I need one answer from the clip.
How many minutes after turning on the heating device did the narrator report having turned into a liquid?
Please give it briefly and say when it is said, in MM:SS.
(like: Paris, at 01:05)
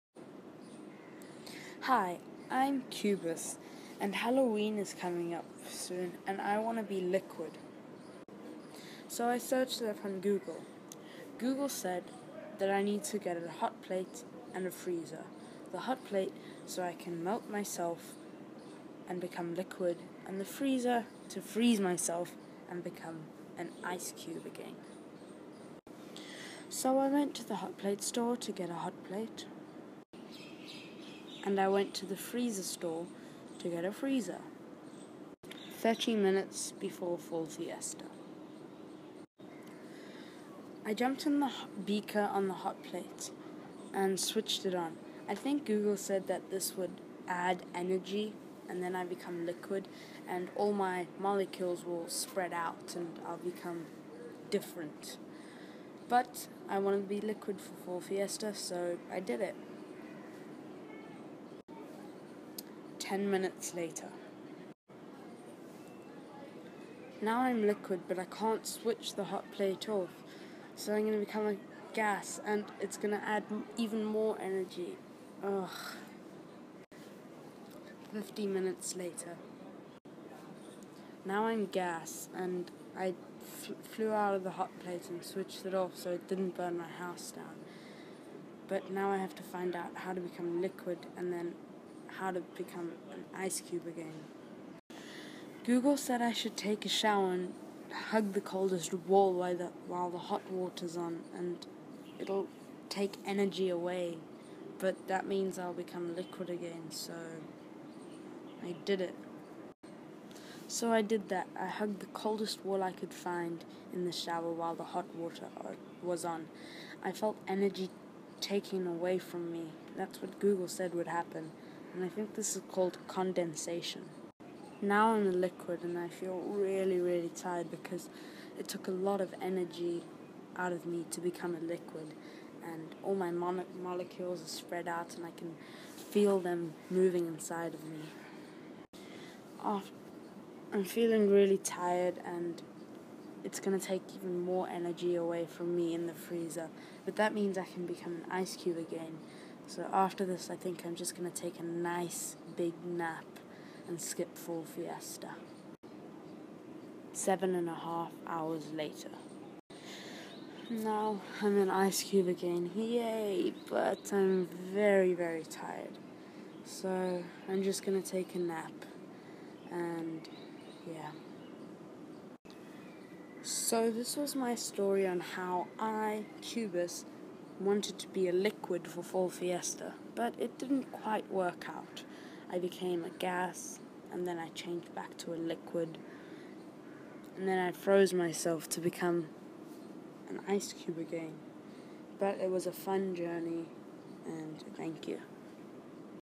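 10, at 01:03.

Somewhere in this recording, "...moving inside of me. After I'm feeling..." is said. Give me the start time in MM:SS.
02:16.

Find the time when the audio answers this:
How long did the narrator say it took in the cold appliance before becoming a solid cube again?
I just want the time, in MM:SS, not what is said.
02:37.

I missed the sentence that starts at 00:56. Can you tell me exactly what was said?
But I wanted to be liquid for Fall Fiesta, so I did it.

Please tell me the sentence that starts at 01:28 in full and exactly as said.
But now I have to find out how to become liquid and then how to become an ice cube again.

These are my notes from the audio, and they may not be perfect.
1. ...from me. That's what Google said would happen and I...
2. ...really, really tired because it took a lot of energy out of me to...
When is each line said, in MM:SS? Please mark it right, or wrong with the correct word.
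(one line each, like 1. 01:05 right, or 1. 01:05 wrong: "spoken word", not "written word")
1. 01:59 right
2. 02:06 right.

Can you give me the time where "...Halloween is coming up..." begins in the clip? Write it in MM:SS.
00:04.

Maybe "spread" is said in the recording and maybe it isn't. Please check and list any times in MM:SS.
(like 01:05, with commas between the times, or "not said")
00:52, 02:14.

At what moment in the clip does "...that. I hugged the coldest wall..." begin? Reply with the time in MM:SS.
01:51.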